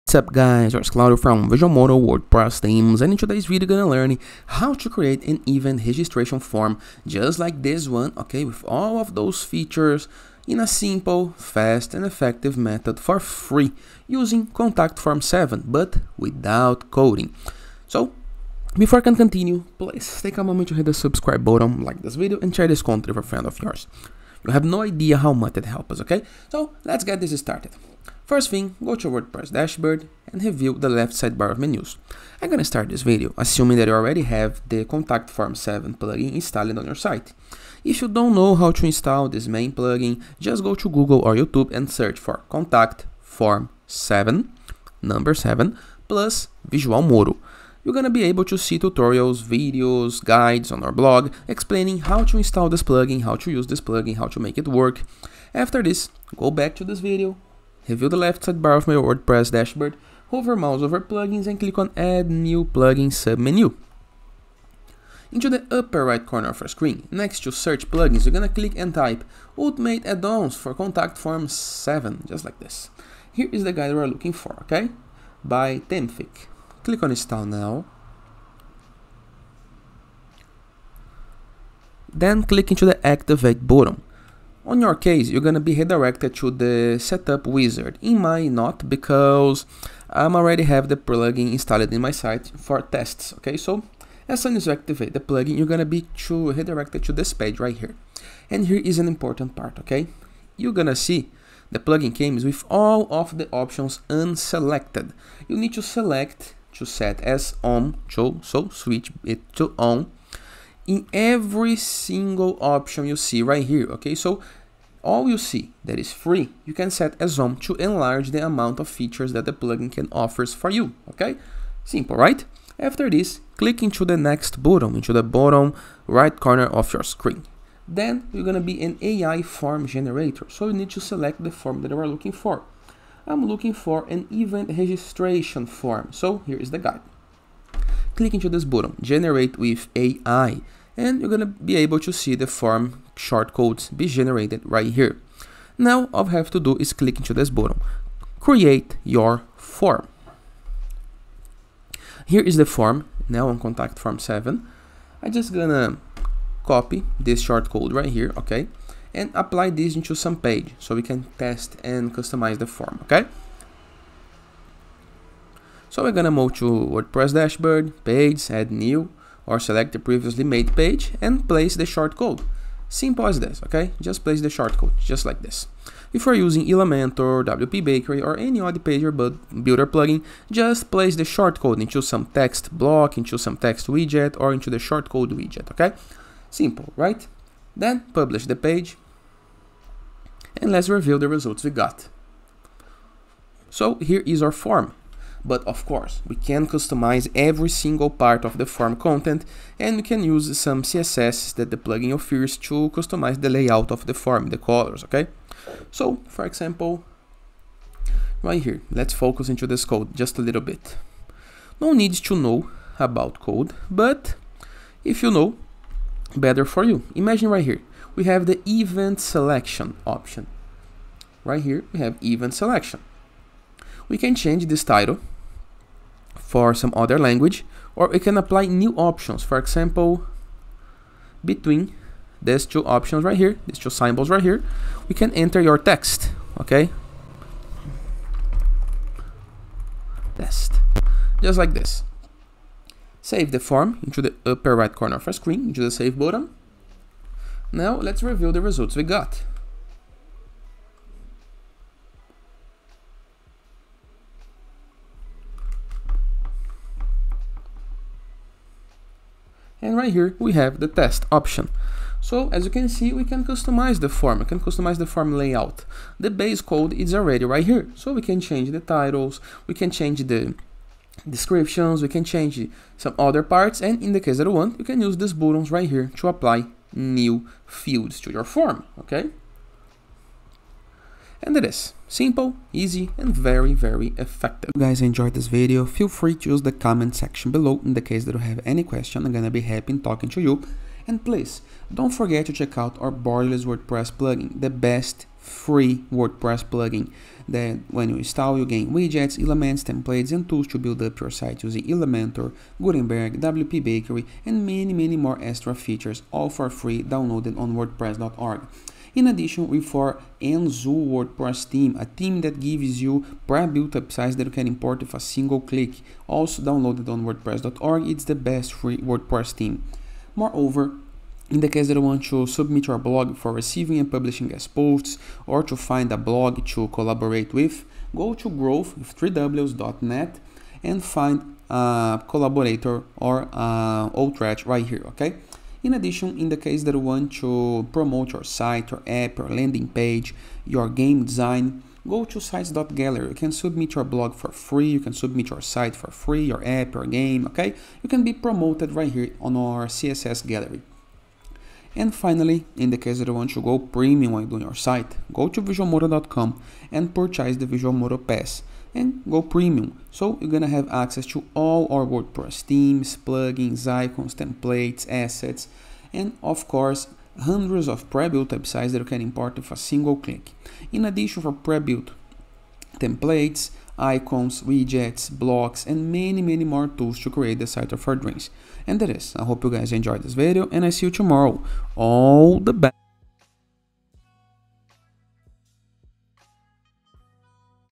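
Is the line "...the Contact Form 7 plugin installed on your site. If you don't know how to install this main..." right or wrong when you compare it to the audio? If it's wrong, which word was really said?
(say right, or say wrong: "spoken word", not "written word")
right.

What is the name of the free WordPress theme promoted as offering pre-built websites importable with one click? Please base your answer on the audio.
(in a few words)
Enzo.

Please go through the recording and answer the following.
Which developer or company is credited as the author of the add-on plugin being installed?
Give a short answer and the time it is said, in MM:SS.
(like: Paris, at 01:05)
Themefic, at 01:15.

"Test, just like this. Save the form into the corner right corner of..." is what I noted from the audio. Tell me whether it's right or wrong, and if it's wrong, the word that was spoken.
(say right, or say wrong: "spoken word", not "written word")
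wrong: "upper", not "corner".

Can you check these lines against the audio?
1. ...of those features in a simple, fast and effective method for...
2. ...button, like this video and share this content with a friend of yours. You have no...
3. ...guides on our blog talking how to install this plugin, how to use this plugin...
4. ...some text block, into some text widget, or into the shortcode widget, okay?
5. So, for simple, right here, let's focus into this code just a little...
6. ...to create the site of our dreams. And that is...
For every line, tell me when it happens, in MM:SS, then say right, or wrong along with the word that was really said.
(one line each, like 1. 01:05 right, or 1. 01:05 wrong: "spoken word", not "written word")
1. 00:08 right
2. 00:21 right
3. 00:50 wrong: "explaining", not "talking"
4. 03:02 right
5. 03:25 wrong: "example", not "simple"
6. 06:17 right.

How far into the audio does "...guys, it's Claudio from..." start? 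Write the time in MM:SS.
00:00.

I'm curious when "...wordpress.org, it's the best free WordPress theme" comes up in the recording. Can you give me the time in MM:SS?
05:17.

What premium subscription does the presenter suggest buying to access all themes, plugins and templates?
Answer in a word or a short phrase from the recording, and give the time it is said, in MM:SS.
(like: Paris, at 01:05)
Visual Pass, at 05:57.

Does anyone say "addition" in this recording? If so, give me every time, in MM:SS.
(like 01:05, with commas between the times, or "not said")
05:09, 05:35, 06:11.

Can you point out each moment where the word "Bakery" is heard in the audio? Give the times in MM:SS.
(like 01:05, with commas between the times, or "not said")
02:57, 05:03.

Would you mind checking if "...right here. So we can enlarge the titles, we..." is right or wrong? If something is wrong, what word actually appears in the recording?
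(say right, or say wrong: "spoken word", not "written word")
wrong: "change", not "enlarge".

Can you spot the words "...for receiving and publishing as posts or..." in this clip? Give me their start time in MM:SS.
05:23.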